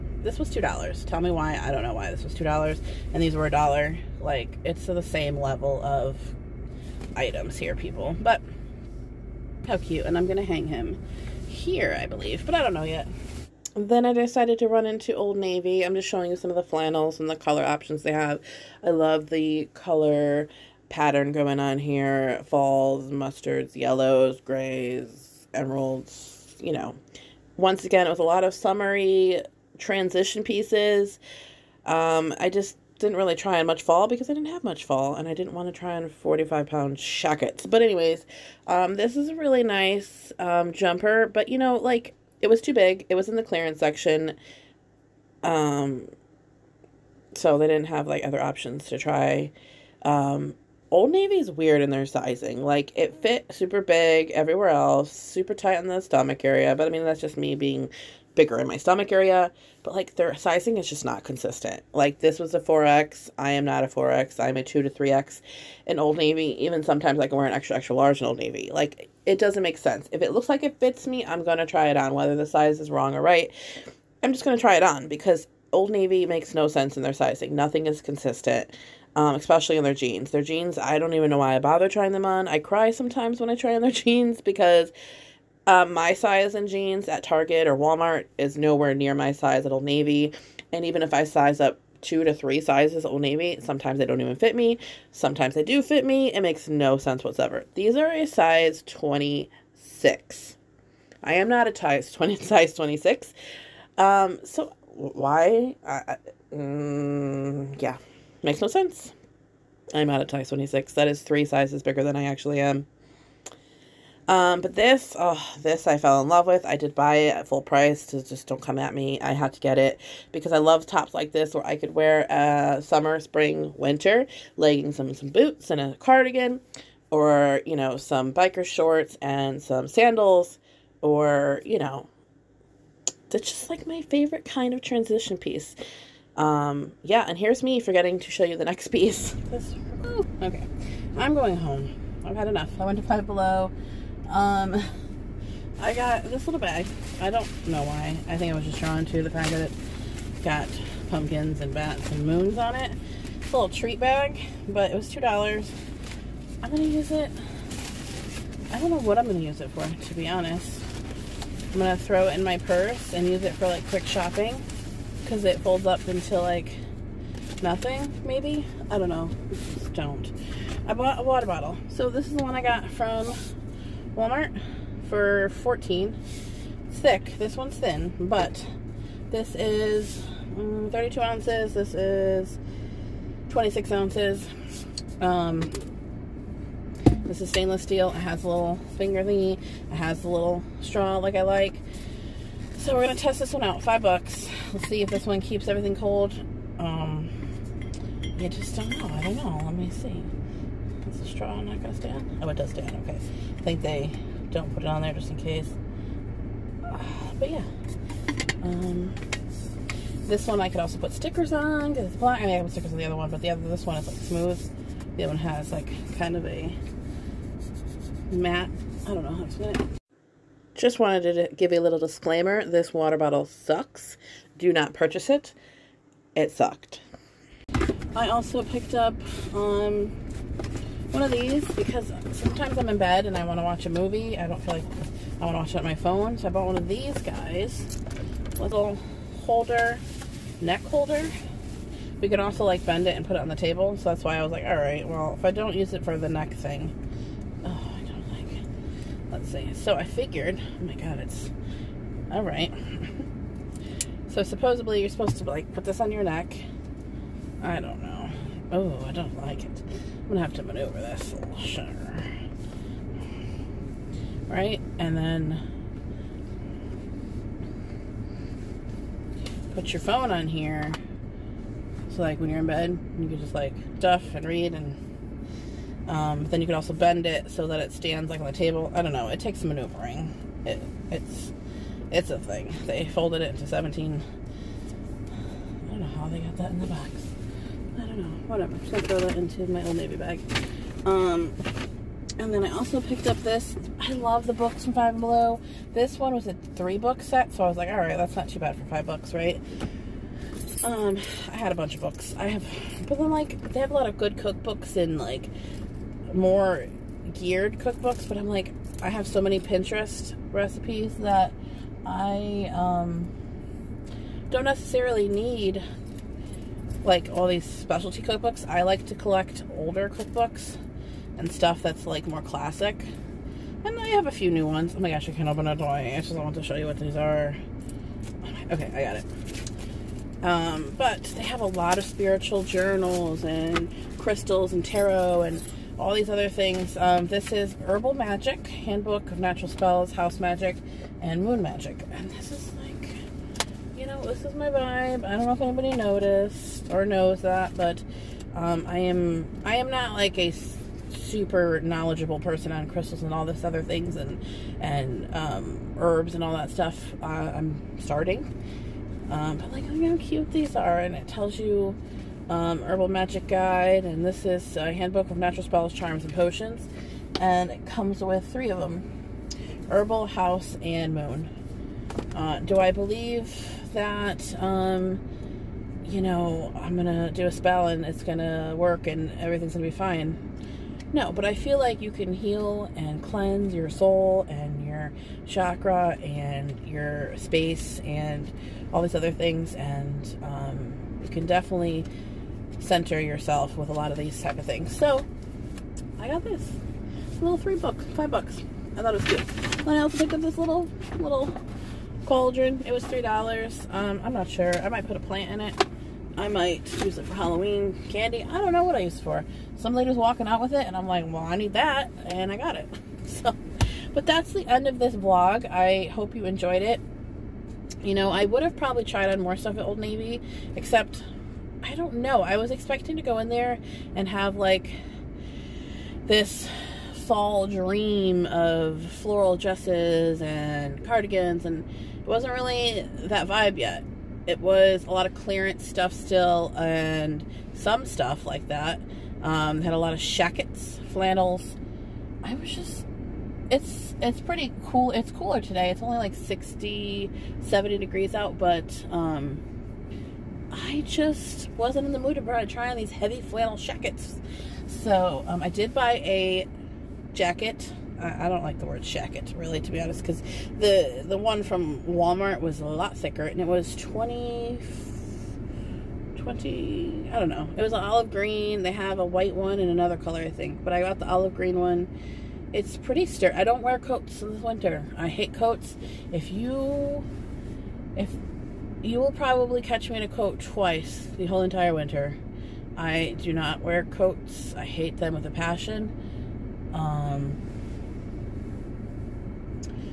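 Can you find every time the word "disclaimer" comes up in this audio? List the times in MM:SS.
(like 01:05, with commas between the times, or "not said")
03:41.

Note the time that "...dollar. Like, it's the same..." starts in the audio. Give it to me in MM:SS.
00:03.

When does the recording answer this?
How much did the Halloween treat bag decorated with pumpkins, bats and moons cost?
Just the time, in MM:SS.
02:34.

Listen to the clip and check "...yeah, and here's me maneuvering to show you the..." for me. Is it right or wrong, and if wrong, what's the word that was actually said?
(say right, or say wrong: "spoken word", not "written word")
wrong: "forgetting", not "maneuvering".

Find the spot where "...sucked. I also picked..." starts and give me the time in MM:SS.
03:46.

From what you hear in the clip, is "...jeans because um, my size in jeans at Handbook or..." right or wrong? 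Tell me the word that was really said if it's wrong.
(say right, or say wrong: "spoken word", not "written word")
wrong: "Target", not "Handbook".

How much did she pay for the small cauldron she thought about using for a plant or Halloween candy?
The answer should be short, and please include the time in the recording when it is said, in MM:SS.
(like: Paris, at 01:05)
$3, at 06:43.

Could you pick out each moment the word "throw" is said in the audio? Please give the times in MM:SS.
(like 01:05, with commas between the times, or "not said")
02:42, 04:49.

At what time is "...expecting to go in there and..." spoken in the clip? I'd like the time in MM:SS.
07:02.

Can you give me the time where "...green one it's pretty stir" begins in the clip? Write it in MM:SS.
07:51.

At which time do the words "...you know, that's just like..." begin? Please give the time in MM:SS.
02:11.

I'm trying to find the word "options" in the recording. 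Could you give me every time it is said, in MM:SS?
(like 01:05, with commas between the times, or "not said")
00:17, 00:48.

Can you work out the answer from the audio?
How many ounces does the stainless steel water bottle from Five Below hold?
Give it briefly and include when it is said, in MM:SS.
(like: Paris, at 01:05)
26 ounces, at 03:03.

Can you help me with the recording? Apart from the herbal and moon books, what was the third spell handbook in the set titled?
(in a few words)
House Magic.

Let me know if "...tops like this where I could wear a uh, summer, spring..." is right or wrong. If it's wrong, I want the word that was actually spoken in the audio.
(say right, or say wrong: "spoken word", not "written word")
right.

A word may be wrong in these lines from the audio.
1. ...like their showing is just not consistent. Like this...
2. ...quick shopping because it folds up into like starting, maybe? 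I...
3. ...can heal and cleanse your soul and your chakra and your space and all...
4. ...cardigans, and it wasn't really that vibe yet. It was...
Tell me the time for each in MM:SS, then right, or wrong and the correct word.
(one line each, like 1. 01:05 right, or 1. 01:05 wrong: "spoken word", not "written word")
1. 00:59 wrong: "sizing", not "showing"
2. 02:43 wrong: "nothing", not "starting"
3. 06:22 right
4. 07:11 right.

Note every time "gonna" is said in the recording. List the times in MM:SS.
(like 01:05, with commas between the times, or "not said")
04:20, 04:48.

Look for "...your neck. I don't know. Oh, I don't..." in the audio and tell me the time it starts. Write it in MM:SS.
04:16.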